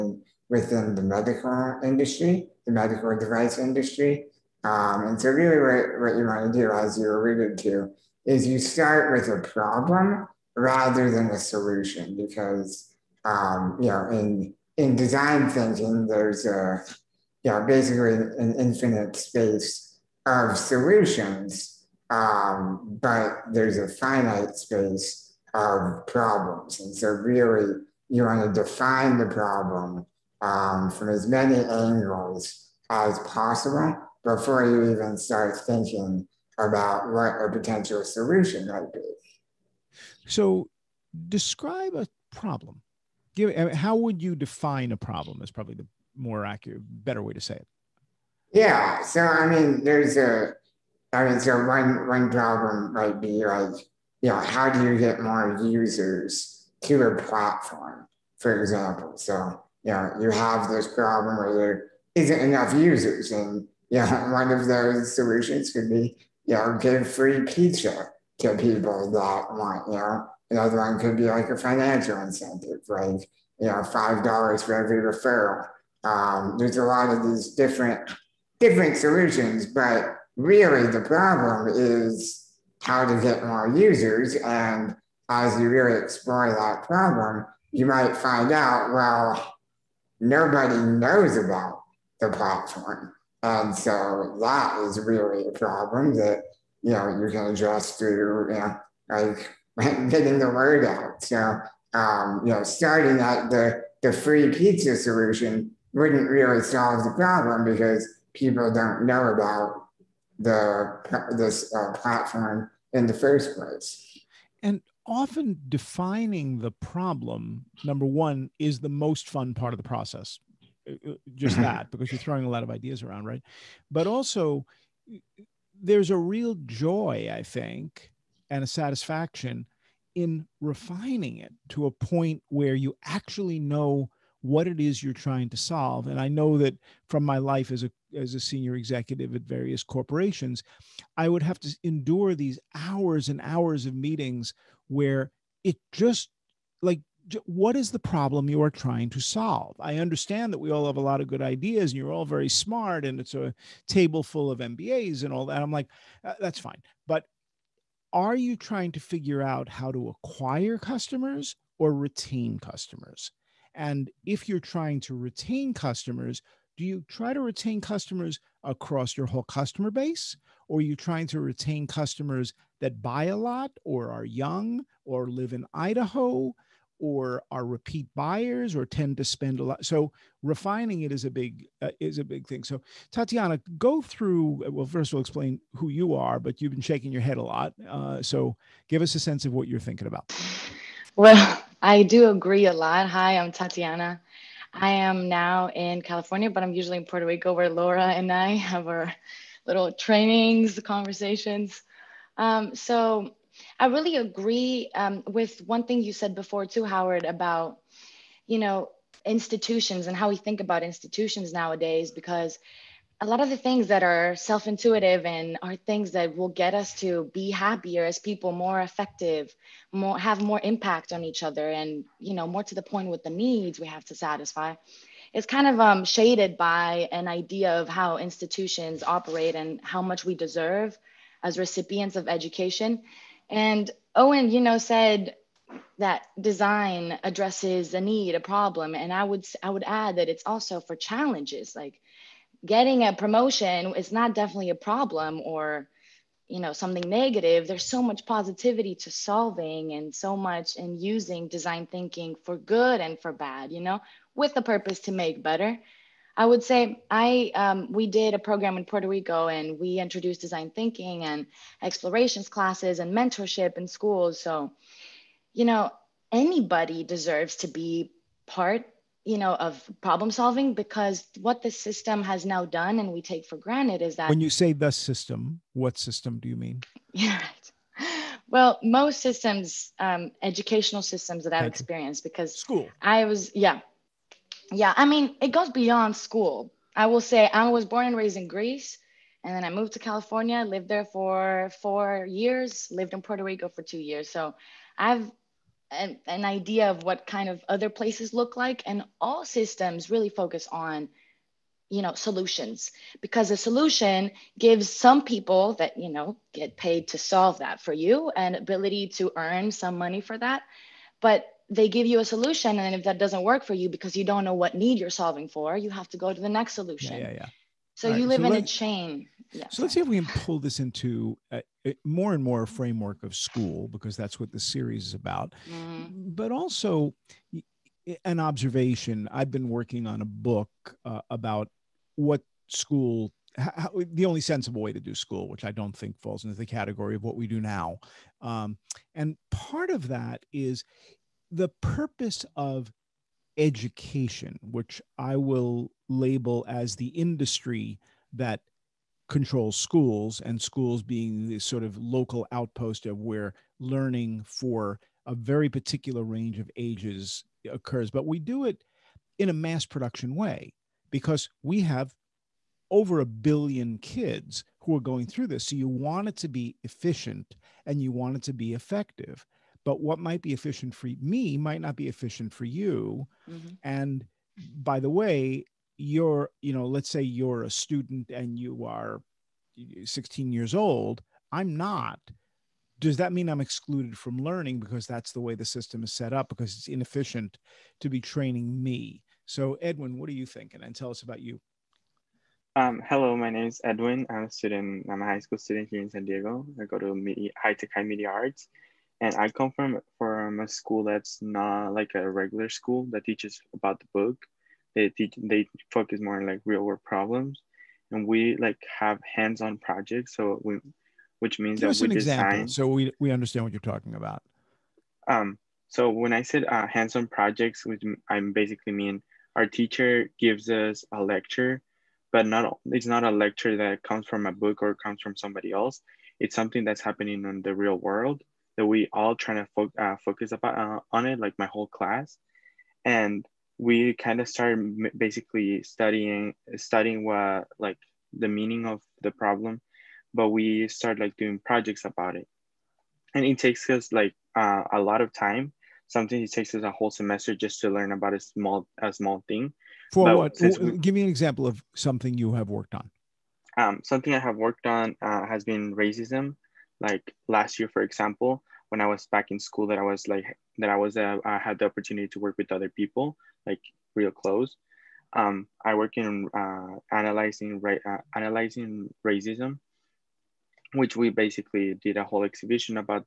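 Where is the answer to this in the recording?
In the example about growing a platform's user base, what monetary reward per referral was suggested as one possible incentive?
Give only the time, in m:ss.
1:13.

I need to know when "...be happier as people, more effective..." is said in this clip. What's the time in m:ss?
3:37.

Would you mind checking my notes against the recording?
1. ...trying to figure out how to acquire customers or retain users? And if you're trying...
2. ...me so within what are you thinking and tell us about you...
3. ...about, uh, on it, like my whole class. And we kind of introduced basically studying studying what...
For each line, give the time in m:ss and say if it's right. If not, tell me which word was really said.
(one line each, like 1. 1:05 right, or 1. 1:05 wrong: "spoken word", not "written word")
1. 2:38 wrong: "customers", not "users"
2. 6:28 wrong: "edwin", not "within"
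3. 7:10 wrong: "started", not "introduced".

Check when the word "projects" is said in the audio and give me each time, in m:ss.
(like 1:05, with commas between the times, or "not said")
6:49, 6:57, 7:21.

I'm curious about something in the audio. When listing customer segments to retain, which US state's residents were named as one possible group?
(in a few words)
Idaho.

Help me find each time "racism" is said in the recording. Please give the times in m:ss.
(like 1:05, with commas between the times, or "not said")
7:35, 7:49.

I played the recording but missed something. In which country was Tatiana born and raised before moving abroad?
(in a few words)
Greece.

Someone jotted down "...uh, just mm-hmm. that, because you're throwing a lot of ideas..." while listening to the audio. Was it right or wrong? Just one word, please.
right.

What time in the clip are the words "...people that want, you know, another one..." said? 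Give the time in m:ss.
1:08.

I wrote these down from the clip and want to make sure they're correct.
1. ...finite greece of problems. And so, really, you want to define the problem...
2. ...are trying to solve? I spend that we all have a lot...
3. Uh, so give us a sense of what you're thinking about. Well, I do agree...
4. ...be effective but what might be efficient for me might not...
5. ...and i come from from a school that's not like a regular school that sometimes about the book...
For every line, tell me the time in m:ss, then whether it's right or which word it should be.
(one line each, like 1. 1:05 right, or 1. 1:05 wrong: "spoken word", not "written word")
1. 0:23 wrong: "space", not "greece"
2. 2:28 wrong: "understand", not "spend"
3. 3:07 right
4. 6:08 right
5. 6:39 wrong: "teaches", not "sometimes".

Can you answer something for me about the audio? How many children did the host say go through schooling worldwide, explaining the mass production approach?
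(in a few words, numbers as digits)
Over a billion.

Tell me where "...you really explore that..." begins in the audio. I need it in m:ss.
1:25.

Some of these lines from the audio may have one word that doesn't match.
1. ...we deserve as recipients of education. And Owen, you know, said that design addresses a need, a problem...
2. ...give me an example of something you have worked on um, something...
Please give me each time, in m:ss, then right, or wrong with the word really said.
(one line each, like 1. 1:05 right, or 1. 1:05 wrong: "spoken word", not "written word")
1. 3:50 right
2. 7:30 right.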